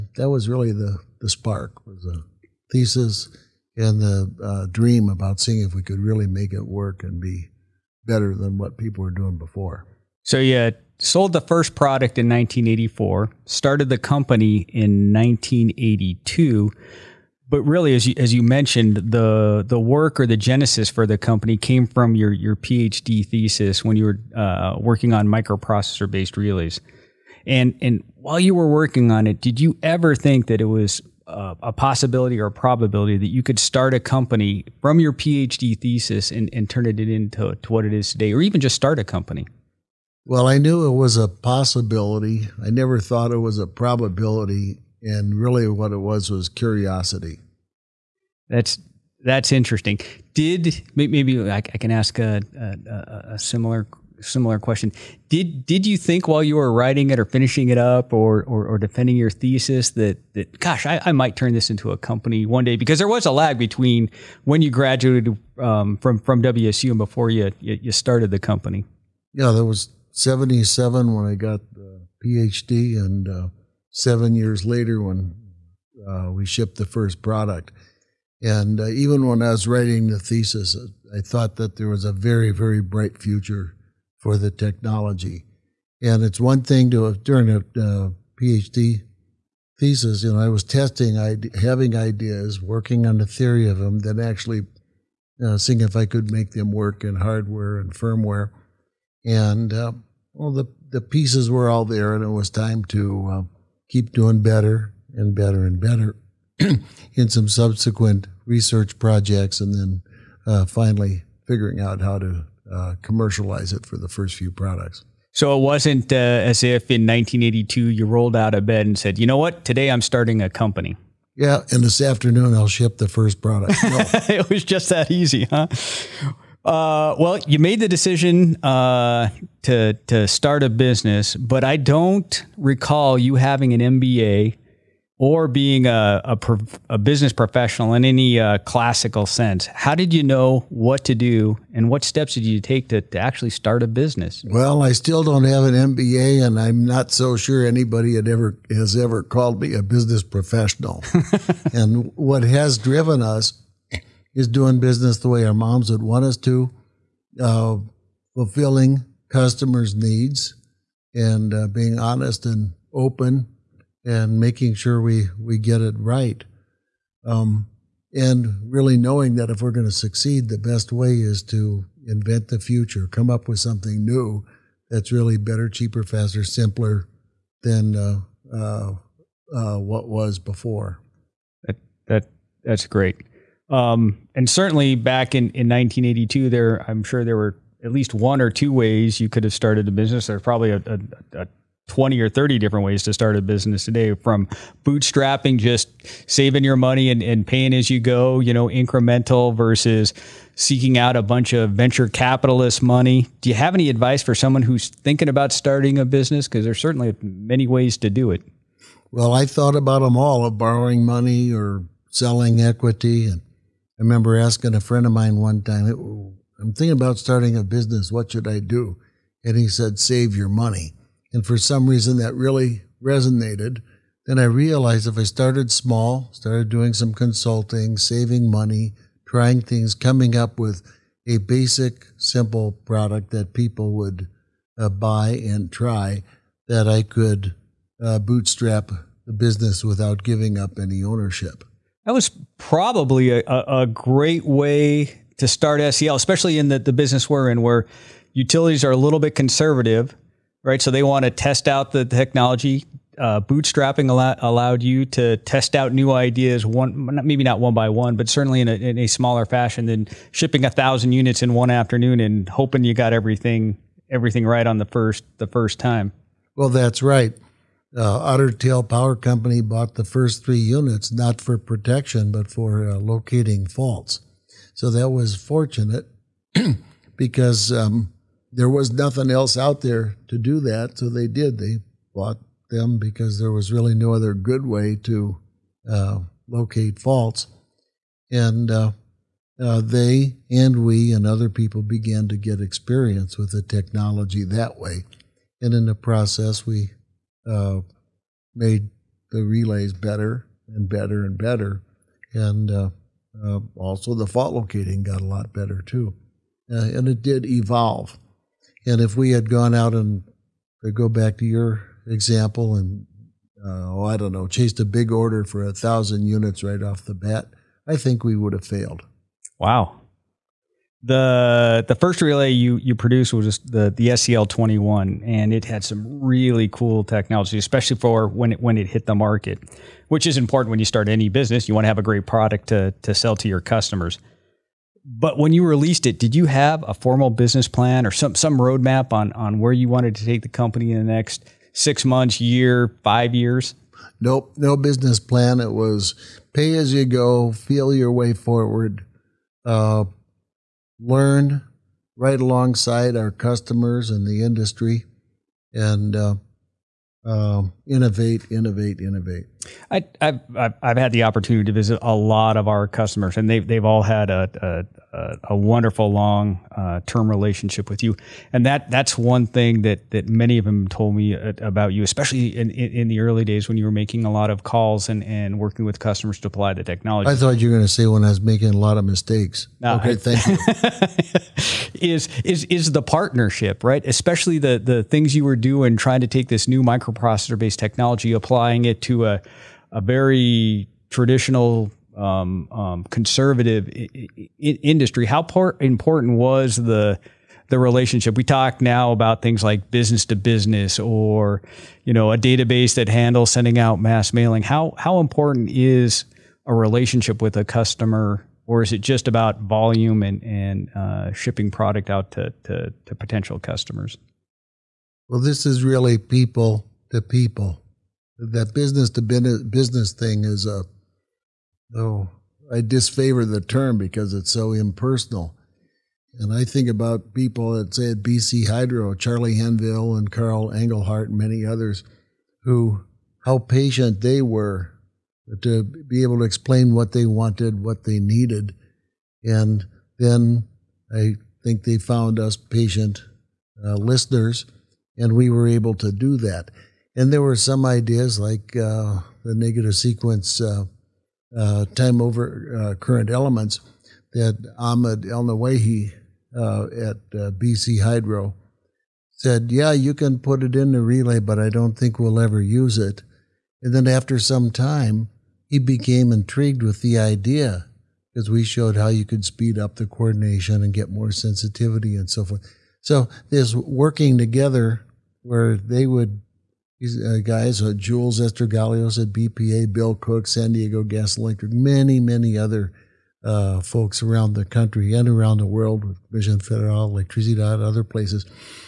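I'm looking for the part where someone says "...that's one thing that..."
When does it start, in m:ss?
6:08.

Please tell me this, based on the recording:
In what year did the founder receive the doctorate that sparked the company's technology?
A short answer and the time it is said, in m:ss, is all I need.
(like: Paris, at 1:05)
1977, at 1:10.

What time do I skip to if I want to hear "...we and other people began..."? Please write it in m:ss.
4:50.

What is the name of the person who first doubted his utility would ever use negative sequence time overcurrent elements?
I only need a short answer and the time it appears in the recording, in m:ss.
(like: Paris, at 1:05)
Ahmed Elneweihi, at 7:34.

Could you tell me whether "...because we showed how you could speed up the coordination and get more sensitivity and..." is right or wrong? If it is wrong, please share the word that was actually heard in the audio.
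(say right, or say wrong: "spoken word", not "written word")
right.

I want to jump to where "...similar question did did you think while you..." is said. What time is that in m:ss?
0:54.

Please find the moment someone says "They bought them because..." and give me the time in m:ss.
4:41.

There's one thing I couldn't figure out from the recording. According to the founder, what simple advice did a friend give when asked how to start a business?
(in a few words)
Save your money.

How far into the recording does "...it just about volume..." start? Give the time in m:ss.
6:48.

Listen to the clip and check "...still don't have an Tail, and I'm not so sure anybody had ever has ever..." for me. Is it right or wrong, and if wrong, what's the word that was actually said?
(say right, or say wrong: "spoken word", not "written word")
wrong: "MBA", not "Tail".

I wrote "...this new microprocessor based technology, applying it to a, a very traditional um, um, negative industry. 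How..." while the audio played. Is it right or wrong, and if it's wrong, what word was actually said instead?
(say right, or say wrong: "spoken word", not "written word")
wrong: "conservative", not "negative".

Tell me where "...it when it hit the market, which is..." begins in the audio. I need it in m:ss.
5:28.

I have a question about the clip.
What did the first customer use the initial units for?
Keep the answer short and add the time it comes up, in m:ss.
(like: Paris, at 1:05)
Locating faults, at 4:32.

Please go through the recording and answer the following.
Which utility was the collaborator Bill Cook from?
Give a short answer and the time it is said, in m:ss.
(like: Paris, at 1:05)
San Diego Gas & Electric, at 8:00.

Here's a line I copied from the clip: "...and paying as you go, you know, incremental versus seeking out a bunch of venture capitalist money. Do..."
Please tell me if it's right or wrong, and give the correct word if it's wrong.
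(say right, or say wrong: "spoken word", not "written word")
right.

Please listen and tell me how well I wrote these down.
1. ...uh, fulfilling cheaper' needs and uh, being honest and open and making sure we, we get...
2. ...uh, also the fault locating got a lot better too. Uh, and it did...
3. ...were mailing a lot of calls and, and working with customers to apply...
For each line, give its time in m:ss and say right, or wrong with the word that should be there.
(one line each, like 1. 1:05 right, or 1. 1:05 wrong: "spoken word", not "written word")
1. 2:37 wrong: "customers", not "cheaper"
2. 5:03 right
3. 6:13 wrong: "making", not "mailing".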